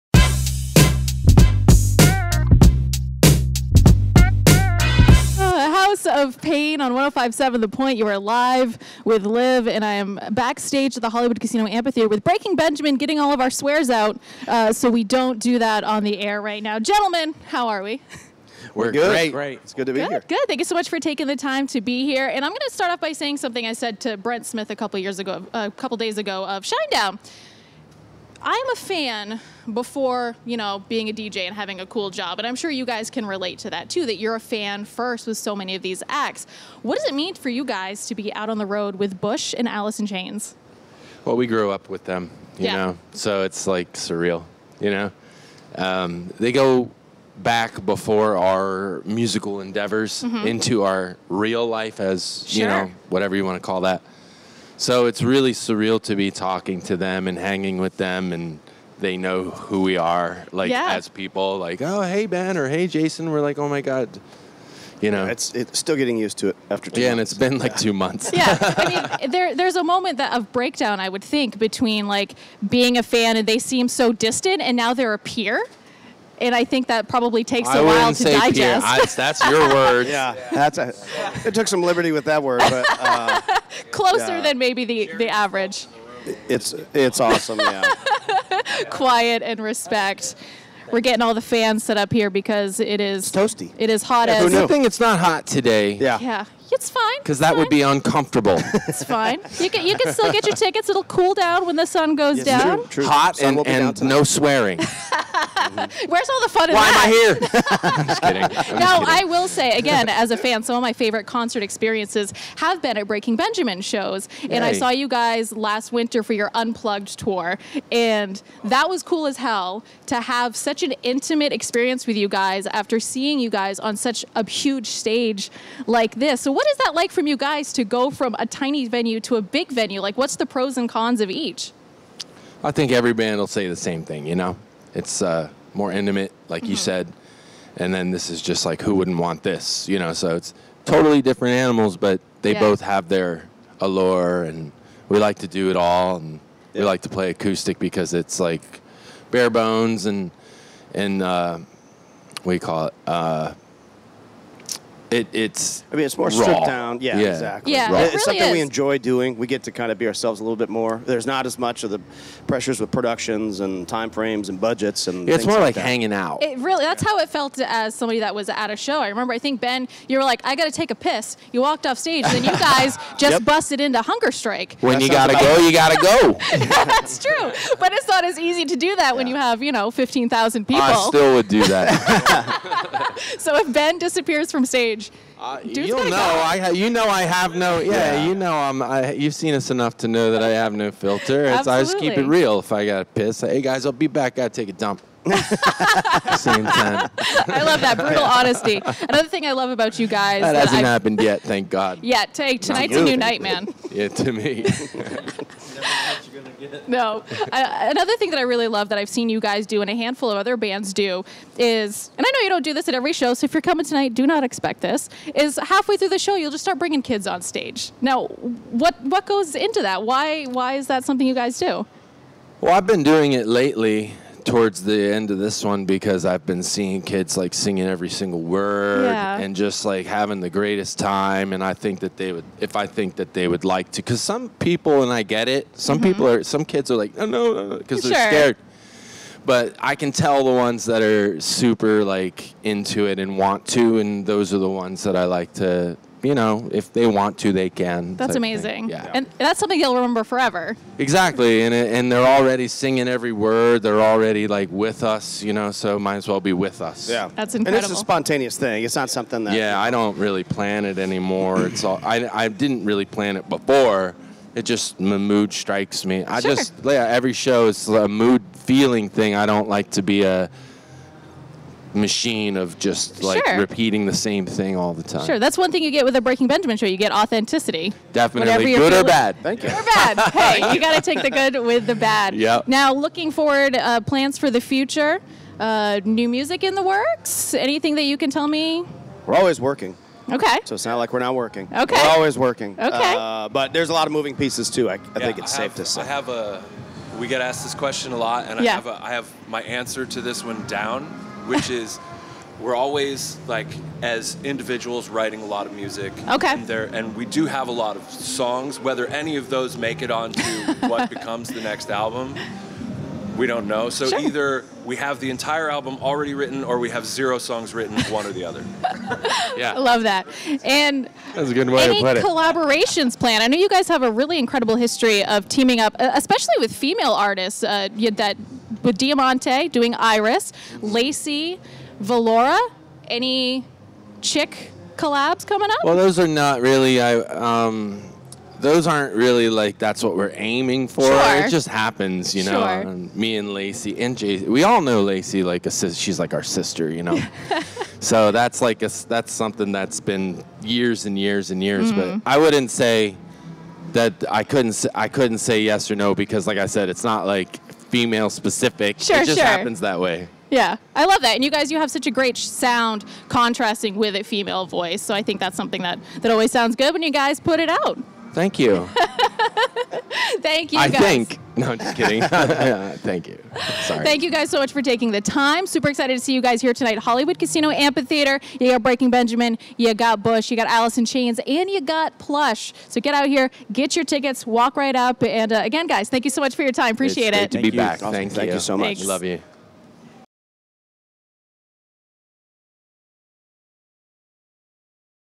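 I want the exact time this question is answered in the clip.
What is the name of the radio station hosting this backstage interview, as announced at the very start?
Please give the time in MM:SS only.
00:06.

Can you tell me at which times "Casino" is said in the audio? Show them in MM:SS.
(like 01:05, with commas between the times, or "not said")
00:11, 06:17.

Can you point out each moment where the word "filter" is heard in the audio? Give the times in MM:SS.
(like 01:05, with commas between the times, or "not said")
03:10.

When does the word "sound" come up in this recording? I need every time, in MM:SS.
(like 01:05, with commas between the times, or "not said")
06:02, 06:06.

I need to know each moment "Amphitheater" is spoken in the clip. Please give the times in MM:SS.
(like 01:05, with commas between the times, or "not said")
00:11, 06:17.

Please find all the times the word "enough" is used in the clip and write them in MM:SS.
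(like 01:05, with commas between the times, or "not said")
03:09.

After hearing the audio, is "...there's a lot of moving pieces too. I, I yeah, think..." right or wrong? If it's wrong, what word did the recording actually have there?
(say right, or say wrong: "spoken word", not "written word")
right.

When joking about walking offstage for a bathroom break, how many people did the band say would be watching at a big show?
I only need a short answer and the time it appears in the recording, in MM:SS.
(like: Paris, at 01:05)
15,000, at 02:59.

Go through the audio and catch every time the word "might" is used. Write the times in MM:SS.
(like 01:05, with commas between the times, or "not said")
04:15.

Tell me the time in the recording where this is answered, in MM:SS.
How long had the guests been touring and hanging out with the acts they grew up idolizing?
01:07.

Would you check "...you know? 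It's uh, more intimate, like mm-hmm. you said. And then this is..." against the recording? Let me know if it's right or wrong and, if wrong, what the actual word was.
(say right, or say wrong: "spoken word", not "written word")
right.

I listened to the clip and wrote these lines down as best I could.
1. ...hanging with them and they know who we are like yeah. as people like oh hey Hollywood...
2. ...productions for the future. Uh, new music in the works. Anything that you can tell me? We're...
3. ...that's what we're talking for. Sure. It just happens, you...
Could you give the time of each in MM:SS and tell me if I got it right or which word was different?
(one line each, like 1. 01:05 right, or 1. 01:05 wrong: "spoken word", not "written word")
1. 00:57 wrong: "Ben", not "Hollywood"
2. 04:44 wrong: "plans", not "productions"
3. 05:39 wrong: "aiming", not "talking".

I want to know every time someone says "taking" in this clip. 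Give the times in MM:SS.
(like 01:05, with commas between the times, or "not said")
00:21, 06:14.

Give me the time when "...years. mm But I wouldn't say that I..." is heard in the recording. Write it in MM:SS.
05:51.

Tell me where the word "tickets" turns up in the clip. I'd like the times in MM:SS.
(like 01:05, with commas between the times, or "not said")
01:40, 06:24.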